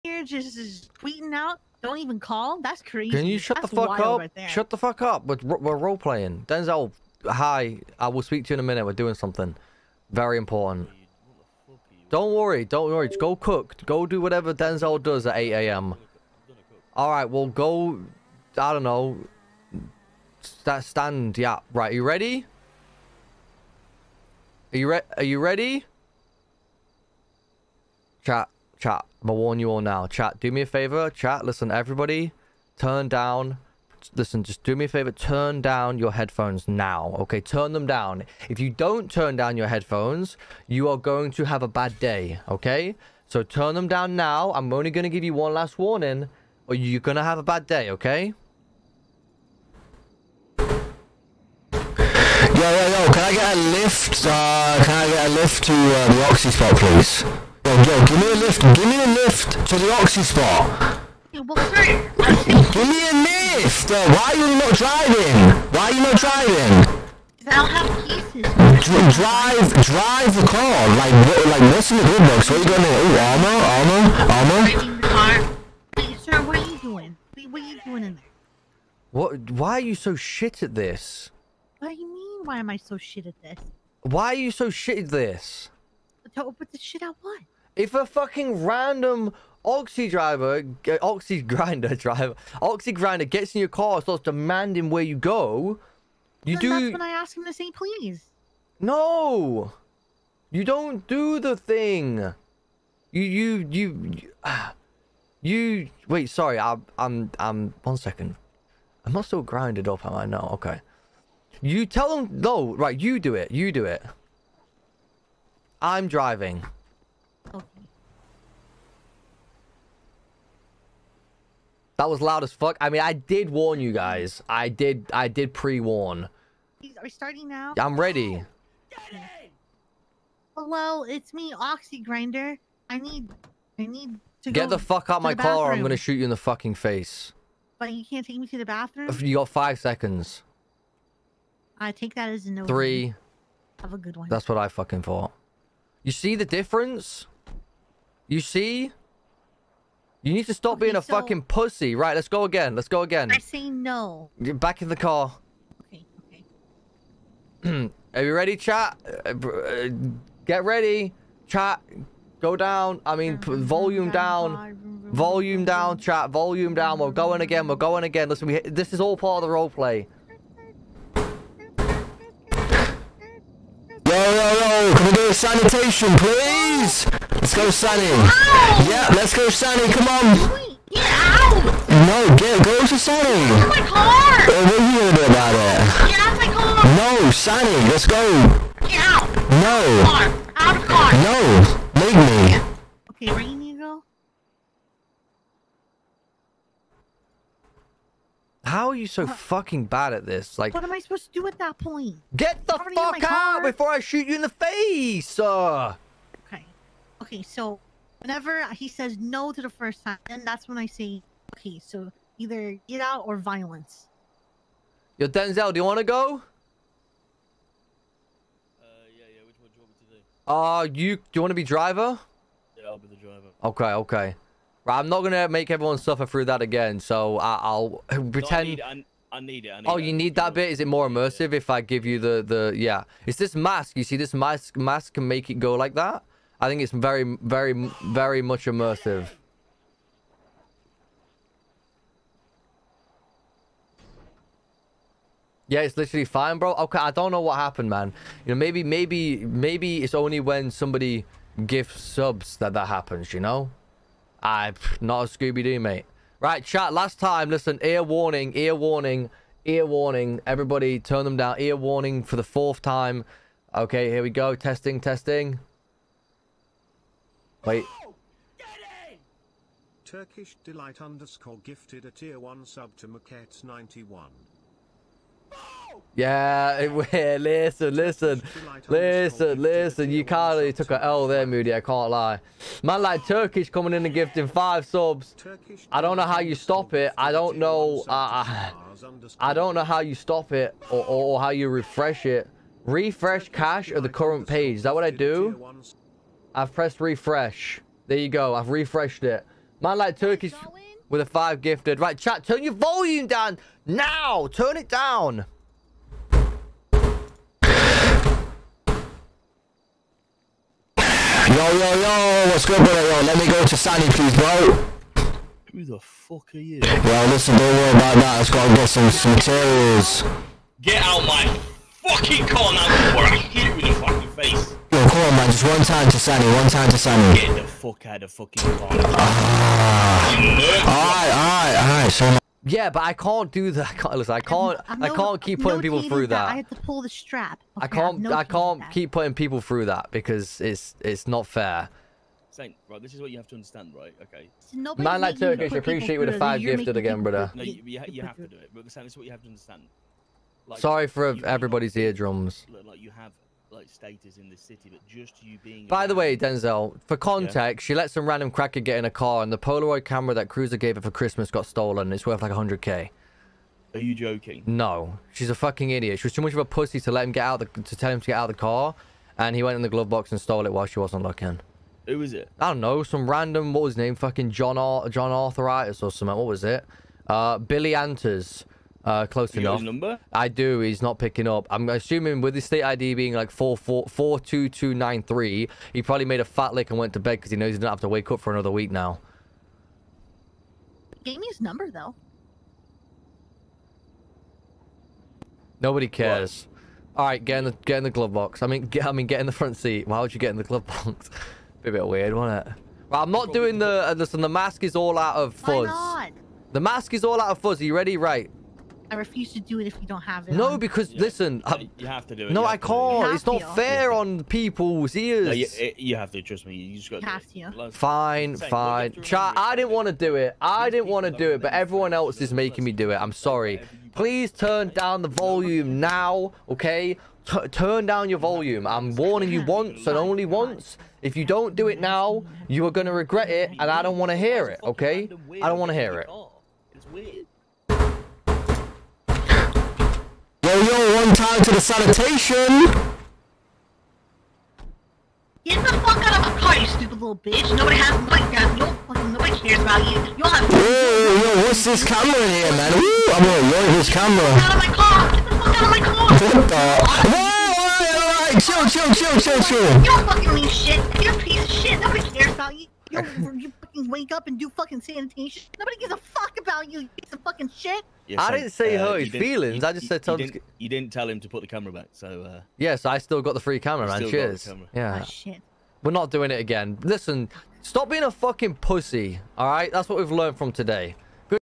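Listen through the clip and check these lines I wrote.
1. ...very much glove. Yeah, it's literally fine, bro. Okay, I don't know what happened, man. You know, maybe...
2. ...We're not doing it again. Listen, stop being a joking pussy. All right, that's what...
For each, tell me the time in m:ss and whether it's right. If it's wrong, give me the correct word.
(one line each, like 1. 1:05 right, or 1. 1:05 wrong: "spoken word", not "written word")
1. 3:58 wrong: "immersive", not "glove"
2. 7:56 wrong: "fucking", not "joking".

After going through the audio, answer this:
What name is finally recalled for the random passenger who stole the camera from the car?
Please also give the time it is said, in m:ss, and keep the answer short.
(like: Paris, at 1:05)
Billy Anters, at 6:17.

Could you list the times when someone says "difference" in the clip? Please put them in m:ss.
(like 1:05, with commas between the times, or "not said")
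2:26.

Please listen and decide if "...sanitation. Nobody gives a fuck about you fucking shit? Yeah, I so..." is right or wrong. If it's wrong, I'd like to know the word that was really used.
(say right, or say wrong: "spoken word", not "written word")
right.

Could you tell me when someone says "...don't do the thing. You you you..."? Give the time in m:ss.
1:40.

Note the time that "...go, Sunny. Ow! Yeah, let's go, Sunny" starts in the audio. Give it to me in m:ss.
2:57.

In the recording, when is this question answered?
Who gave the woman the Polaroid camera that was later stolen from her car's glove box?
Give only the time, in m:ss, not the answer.
6:00.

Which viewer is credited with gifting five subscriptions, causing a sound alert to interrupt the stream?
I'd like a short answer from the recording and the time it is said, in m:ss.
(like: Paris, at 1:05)
Turkish Delight, at 4:30.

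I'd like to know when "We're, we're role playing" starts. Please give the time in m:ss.
0:05.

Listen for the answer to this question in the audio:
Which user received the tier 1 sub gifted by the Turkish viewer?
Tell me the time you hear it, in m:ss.
4:33.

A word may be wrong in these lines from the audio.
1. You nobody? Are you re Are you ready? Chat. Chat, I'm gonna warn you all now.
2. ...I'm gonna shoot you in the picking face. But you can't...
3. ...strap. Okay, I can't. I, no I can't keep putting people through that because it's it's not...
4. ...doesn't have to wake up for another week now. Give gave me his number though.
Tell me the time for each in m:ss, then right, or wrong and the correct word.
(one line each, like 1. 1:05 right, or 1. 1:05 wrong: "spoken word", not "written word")
1. 0:21 wrong: "ready", not "nobody"
2. 2:15 wrong: "fucking", not "picking"
3. 5:37 right
4. 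6:27 right.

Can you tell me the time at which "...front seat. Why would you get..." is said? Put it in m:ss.
6:39.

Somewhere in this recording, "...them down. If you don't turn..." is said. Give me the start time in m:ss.
0:37.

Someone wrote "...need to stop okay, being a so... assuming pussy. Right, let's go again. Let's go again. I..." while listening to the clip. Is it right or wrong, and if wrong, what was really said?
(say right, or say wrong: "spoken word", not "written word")
wrong: "fucking", not "assuming".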